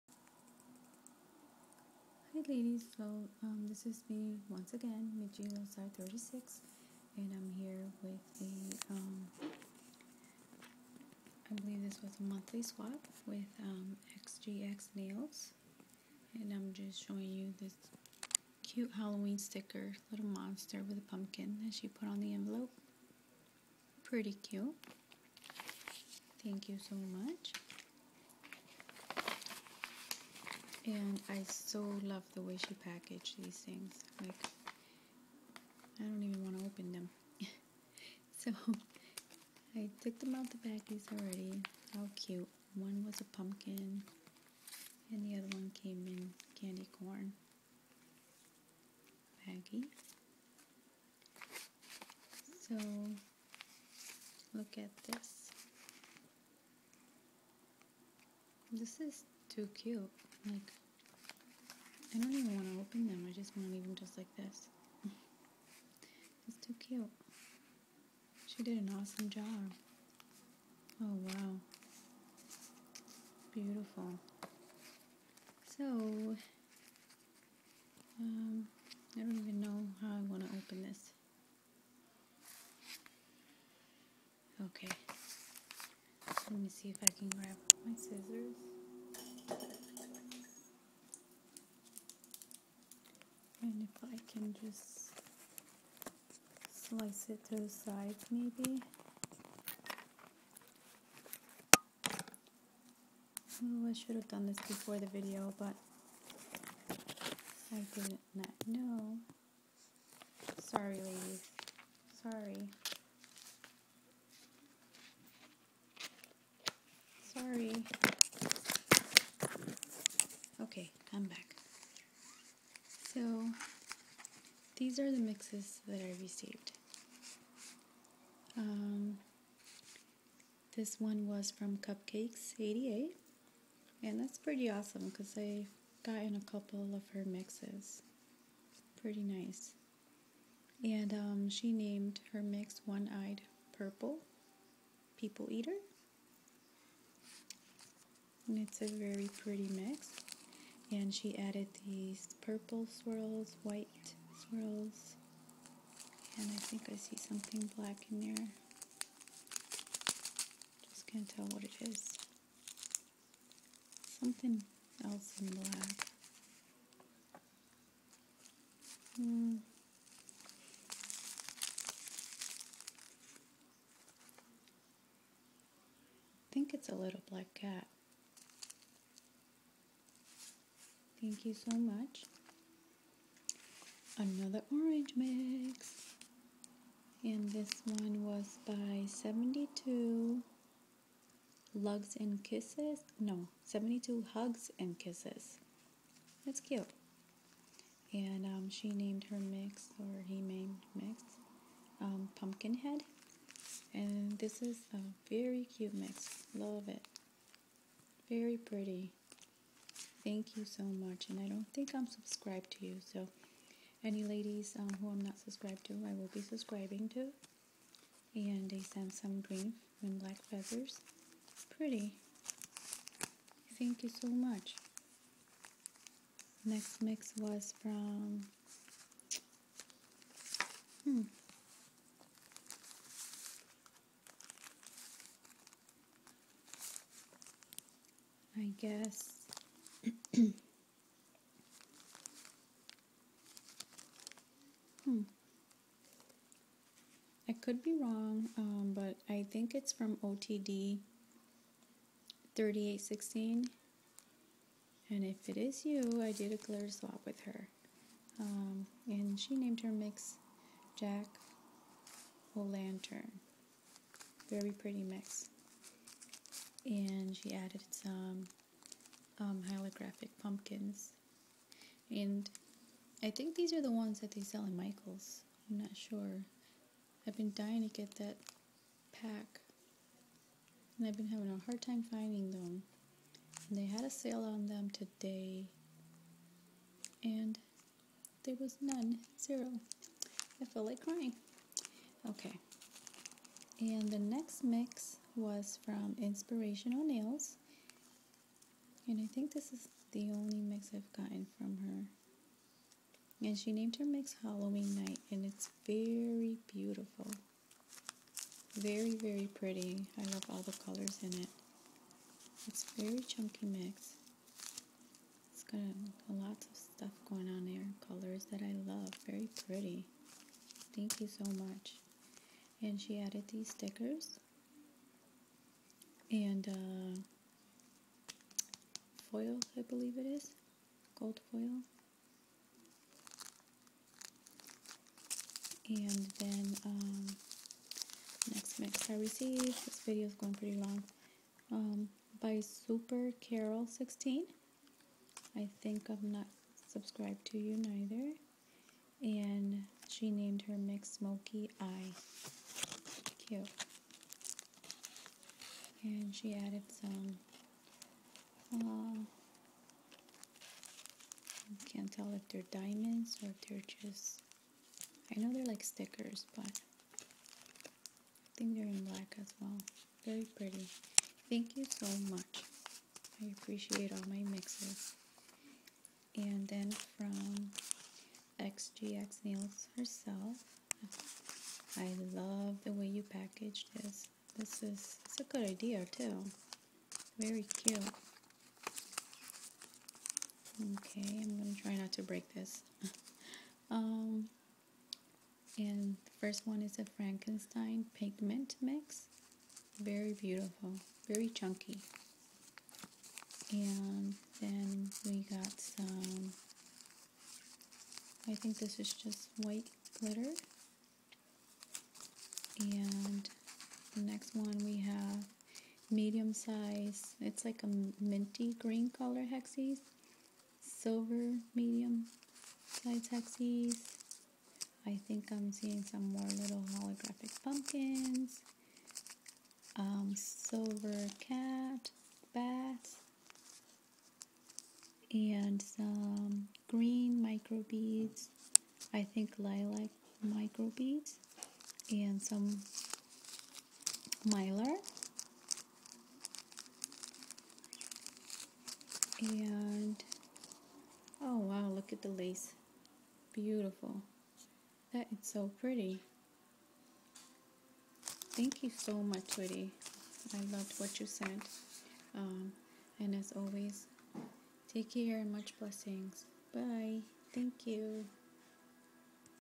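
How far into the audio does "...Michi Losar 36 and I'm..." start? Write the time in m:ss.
0:05.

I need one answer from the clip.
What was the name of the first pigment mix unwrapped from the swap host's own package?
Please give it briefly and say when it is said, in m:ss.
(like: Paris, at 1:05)
Frankenstein, at 6:37.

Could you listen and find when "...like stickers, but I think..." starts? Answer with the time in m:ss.
6:05.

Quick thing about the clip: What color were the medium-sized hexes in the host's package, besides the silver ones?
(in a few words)
minty green.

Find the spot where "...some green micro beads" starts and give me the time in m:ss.
7:15.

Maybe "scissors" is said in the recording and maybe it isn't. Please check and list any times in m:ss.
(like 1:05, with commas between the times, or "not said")
1:27.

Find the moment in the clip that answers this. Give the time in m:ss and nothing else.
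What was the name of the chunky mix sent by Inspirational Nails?
5:04.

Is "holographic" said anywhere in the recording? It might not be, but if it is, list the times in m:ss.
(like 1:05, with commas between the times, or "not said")
4:29, 7:06.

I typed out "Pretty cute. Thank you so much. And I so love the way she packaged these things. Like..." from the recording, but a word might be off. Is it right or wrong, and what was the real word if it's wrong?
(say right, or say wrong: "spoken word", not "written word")
right.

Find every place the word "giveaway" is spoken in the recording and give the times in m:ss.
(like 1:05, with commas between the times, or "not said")
not said.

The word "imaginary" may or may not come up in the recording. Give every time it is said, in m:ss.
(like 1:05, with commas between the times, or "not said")
not said.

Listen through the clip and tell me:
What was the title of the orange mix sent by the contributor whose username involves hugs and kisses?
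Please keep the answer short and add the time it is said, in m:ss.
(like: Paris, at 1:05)
Pumpkinhead, at 3:22.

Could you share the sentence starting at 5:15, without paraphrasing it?
It's got a, lots of stuff going on there, colors that I love.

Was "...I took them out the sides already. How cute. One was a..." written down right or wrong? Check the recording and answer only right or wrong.
wrong.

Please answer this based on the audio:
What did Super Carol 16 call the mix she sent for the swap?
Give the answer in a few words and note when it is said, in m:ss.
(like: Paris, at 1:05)
Smoky Eye, at 5:51.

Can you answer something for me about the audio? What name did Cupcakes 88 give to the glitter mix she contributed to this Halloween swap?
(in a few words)
One Eyed Purple People Eater.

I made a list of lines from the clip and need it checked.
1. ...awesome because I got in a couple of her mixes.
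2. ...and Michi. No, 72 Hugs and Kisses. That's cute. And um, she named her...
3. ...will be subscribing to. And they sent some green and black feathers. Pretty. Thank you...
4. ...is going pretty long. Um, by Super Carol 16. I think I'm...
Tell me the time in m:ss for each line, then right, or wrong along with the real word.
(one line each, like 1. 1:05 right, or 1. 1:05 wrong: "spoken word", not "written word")
1. 2:14 right
2. 3:12 wrong: "Kisses", not "Michi"
3. 3:36 right
4. 5:40 right.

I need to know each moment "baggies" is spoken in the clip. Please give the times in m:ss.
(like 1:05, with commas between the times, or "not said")
0:40, 0:49.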